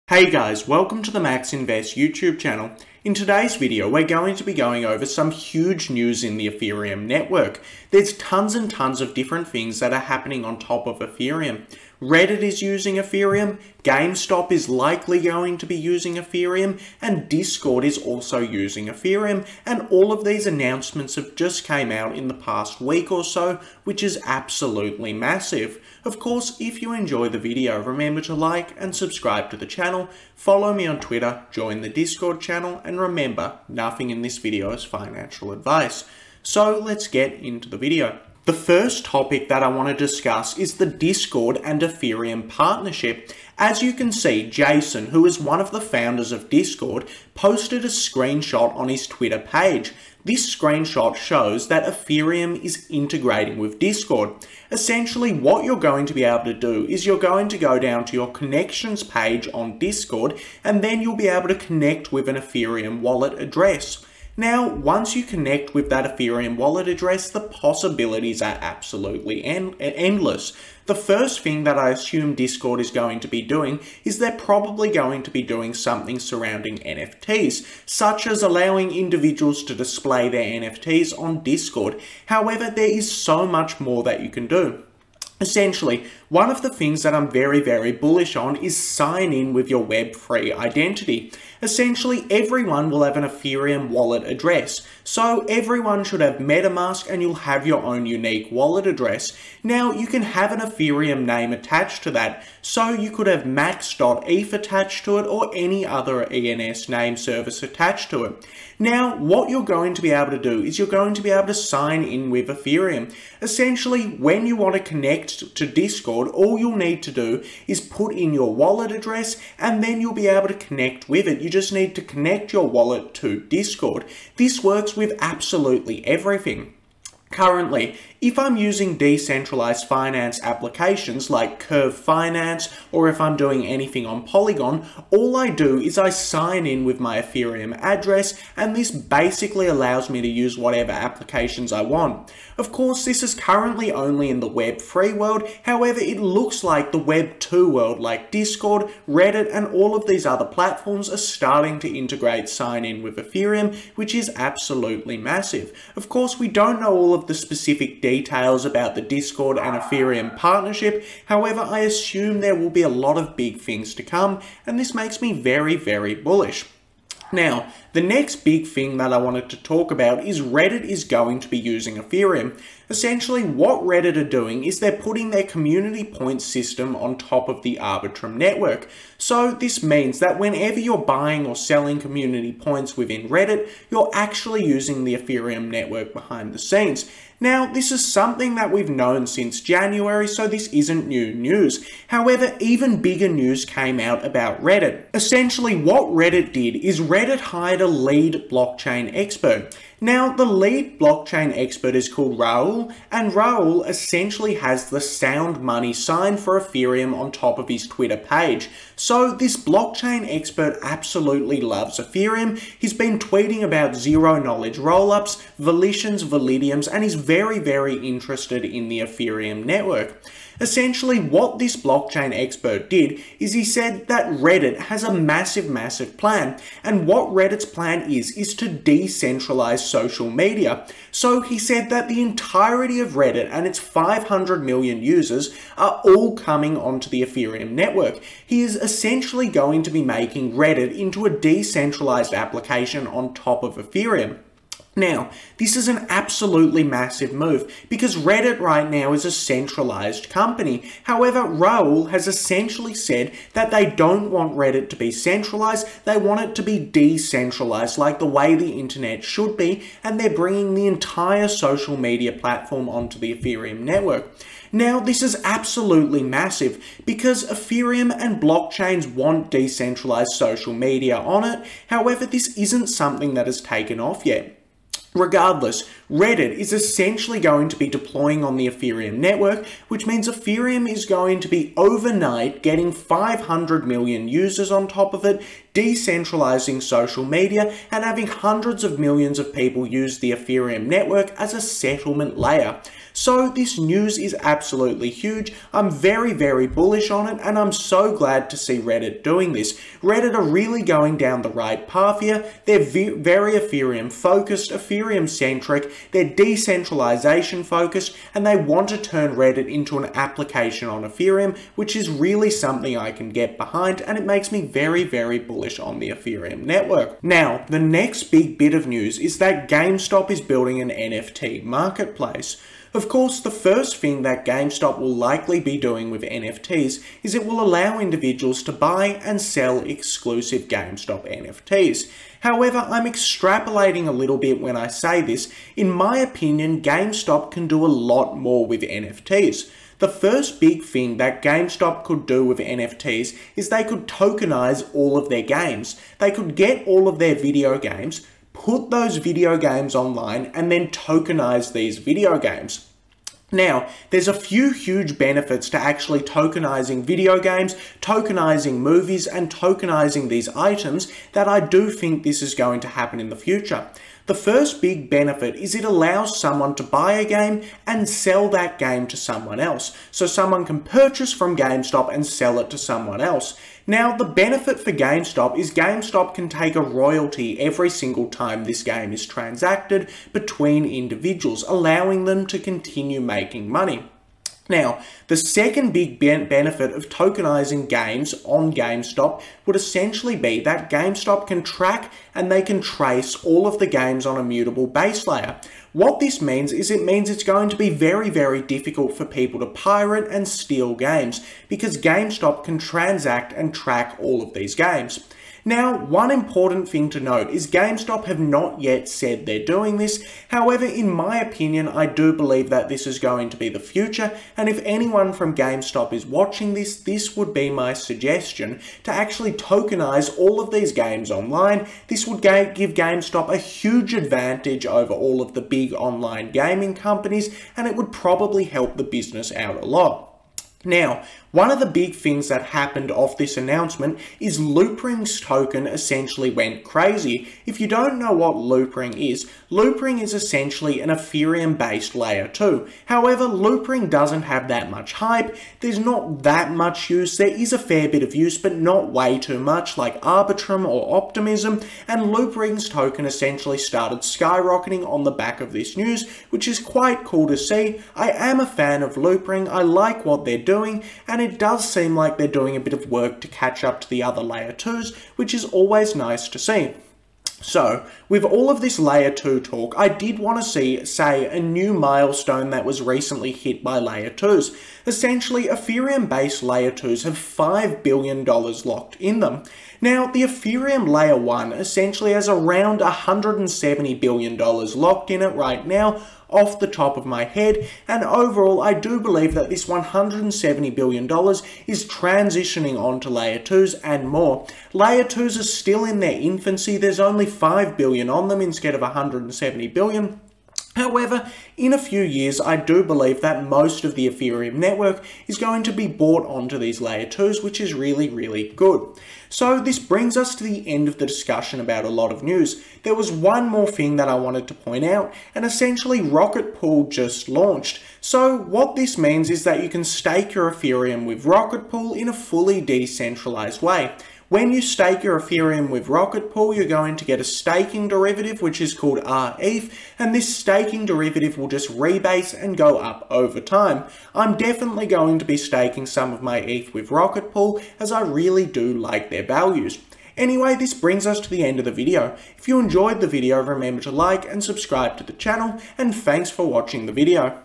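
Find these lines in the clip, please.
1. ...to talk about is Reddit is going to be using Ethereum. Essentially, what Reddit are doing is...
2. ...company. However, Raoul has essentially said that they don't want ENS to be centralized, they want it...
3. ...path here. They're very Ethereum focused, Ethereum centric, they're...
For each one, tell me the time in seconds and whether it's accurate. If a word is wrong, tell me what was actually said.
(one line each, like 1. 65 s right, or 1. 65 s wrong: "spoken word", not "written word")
1. 169 s right
2. 250 s wrong: "Reddit", not "ENS"
3. 301 s right.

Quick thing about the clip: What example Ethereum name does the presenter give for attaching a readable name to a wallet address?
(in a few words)
max.eth.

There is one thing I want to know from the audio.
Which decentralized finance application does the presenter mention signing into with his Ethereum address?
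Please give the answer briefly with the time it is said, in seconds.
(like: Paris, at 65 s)
Curve Finance, at 131 s.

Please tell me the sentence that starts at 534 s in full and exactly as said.
I'm definitely going to be staking some of my ETH with Rocket Pool, as I really do like their values.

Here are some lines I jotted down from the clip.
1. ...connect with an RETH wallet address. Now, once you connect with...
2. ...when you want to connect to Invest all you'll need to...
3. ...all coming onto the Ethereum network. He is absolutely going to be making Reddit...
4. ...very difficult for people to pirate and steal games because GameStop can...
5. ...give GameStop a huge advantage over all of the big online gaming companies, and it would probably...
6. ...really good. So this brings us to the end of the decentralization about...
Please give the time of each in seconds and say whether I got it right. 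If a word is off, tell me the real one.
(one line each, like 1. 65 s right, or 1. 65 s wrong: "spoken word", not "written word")
1. 61 s wrong: "Ethereum", not "RETH"
2. 114 s wrong: "Discord", not "Invest"
3. 236 s wrong: "essentially", not "absolutely"
4. 398 s right
5. 422 s right
6. 508 s wrong: "discussion", not "decentralization".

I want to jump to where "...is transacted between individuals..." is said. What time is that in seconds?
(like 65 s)
379 s.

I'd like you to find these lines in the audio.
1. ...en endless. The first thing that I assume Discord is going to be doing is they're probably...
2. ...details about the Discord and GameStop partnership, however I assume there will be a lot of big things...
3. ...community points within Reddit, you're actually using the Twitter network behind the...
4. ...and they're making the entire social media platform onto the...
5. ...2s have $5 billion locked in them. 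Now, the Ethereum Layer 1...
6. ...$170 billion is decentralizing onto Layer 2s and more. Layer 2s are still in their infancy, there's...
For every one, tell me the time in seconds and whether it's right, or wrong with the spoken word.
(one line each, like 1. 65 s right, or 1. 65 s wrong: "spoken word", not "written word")
1. 69 s right
2. 158 s wrong: "Ethereum", not "GameStop"
3. 181 s wrong: "Ethereum", not "Twitter"
4. 260 s wrong: "bringing", not "making"
5. 476 s right
6. 489 s wrong: "transitioning", not "decentralizing".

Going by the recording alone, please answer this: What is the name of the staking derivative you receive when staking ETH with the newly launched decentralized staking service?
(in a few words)
rETH.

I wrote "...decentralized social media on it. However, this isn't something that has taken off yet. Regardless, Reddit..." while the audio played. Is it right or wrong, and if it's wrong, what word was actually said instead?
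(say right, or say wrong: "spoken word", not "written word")
right.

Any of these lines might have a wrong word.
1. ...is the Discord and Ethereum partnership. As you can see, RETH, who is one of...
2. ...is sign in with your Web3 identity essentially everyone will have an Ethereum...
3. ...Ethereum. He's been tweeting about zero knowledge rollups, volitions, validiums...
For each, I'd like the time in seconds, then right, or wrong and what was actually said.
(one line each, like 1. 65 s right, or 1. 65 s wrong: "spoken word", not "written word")
1. 40 s wrong: "Jason", not "RETH"
2. 88 s right
3. 211 s right.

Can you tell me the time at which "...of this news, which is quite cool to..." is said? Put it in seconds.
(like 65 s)
455 s.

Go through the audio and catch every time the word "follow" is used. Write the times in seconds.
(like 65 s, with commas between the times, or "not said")
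30 s.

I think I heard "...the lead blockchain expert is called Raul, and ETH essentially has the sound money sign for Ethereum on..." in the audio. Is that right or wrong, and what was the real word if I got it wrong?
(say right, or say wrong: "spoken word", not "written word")
wrong: "Raul", not "ETH".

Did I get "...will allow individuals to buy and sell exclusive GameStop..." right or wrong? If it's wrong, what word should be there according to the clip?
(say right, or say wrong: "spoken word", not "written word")
right.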